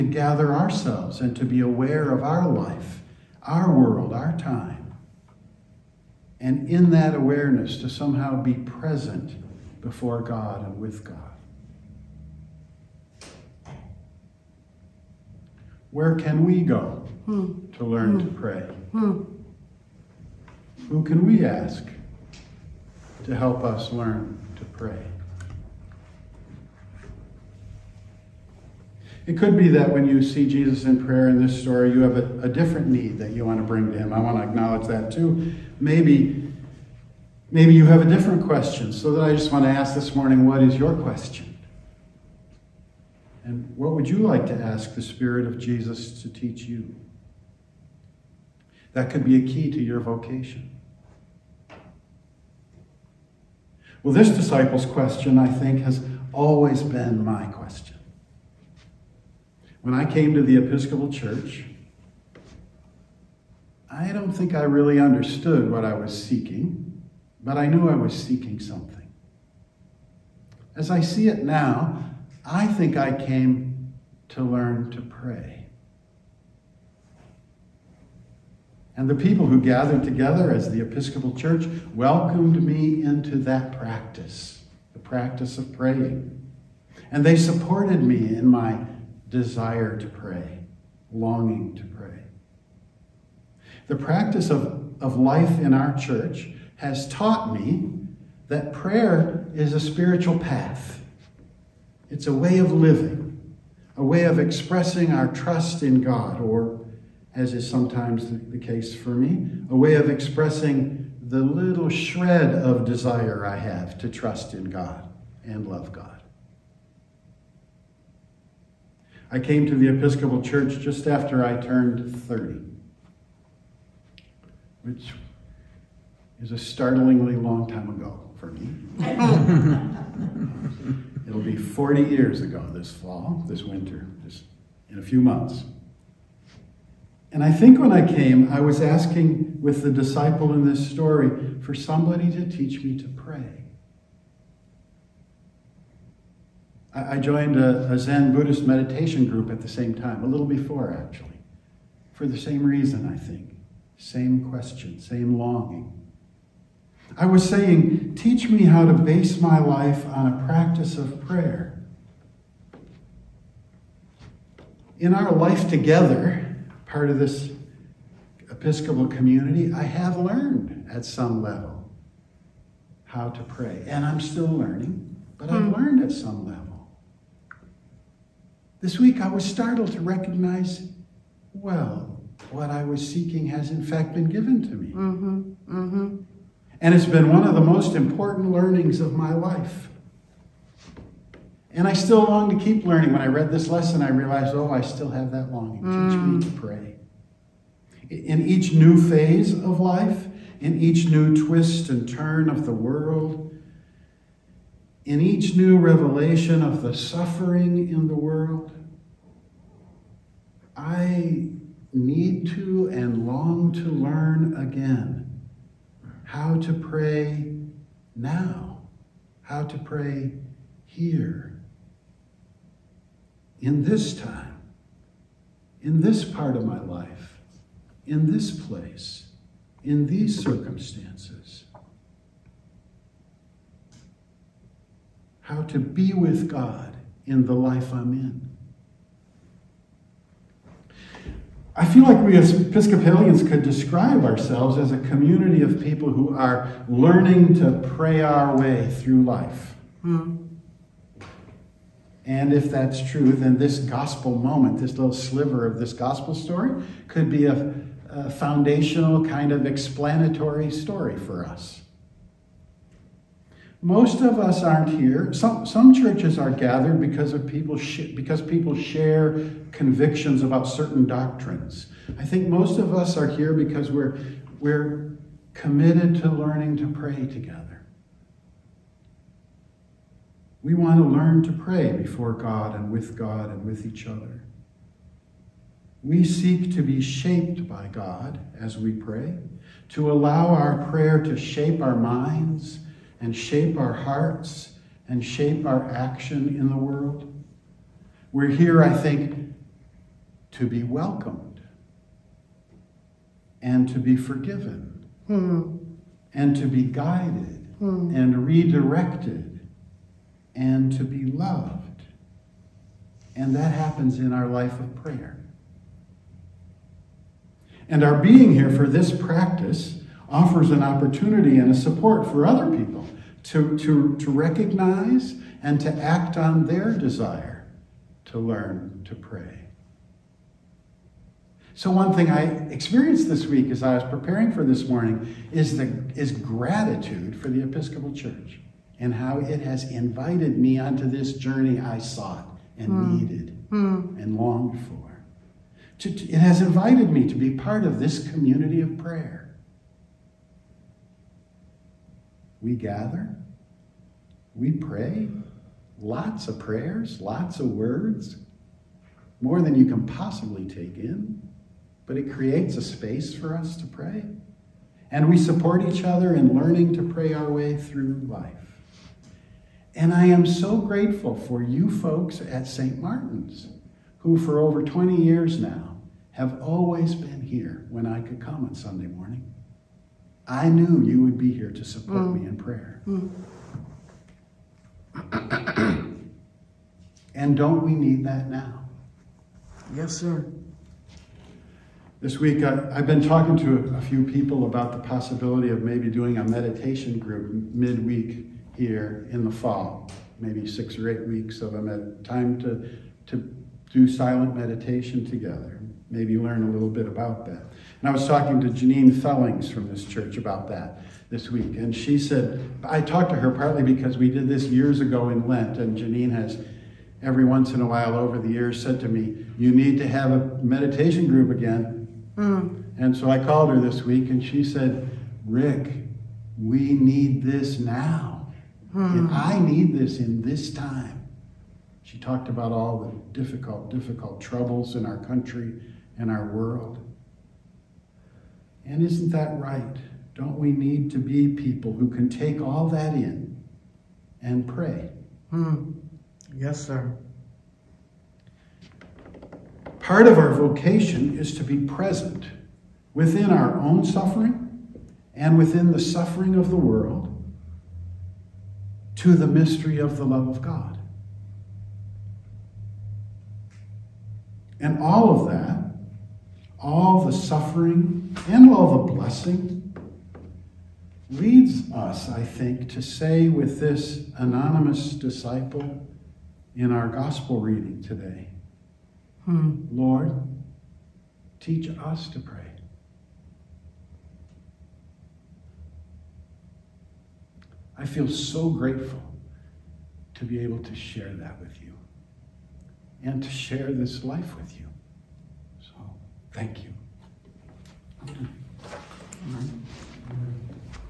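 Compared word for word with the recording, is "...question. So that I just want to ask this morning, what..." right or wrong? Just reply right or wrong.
right.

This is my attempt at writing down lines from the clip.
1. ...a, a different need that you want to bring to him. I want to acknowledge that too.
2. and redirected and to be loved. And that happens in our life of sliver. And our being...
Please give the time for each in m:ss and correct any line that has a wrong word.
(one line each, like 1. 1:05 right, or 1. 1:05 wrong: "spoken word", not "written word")
1. 0:32 right
2. 5:08 wrong: "prayer", not "sliver".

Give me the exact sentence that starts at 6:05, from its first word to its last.
And we support each other in learning to pray our way through life.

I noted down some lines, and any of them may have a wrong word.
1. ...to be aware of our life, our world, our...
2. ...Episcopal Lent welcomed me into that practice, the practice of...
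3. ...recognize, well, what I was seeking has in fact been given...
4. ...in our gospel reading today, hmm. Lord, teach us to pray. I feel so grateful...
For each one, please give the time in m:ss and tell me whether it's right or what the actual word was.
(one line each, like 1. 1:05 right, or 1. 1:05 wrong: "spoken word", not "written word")
1. 0:01 right
2. 1:20 wrong: "Church", not "Lent"
3. 3:00 right
4. 7:56 right.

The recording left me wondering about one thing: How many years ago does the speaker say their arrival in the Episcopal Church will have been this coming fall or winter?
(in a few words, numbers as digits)
40.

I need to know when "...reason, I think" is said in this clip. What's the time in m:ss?
2:32.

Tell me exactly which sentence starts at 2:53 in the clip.
And I'm still learning, but I've hmm.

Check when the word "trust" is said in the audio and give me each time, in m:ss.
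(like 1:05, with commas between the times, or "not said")
1:45, 1:54.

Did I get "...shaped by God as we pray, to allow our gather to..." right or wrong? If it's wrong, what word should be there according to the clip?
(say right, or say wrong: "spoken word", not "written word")
wrong: "prayer", not "gather".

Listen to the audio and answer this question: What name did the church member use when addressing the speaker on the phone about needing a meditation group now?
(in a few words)
Rick.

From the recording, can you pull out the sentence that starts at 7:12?
She talked about all the difficult, difficult troubles in our country and our world.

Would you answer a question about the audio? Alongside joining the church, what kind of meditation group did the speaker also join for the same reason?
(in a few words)
Zen Buddhist.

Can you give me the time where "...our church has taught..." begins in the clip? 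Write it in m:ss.
1:35.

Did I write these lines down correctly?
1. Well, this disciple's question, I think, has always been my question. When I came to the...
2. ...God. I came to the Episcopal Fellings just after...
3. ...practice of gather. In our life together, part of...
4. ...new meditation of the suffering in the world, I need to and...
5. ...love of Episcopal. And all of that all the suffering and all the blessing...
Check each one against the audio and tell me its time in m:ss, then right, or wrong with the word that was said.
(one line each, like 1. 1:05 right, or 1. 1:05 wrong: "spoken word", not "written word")
1. 0:54 right
2. 1:55 wrong: "Church", not "Fellings"
3. 2:40 wrong: "prayer", not "gather"
4. 3:25 wrong: "revelation", not "meditation"
5. 7:40 wrong: "God", not "Episcopal".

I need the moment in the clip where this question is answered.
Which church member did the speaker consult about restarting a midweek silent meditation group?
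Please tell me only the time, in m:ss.
6:48.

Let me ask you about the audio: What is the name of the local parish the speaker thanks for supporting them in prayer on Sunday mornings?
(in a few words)
St. Martin's.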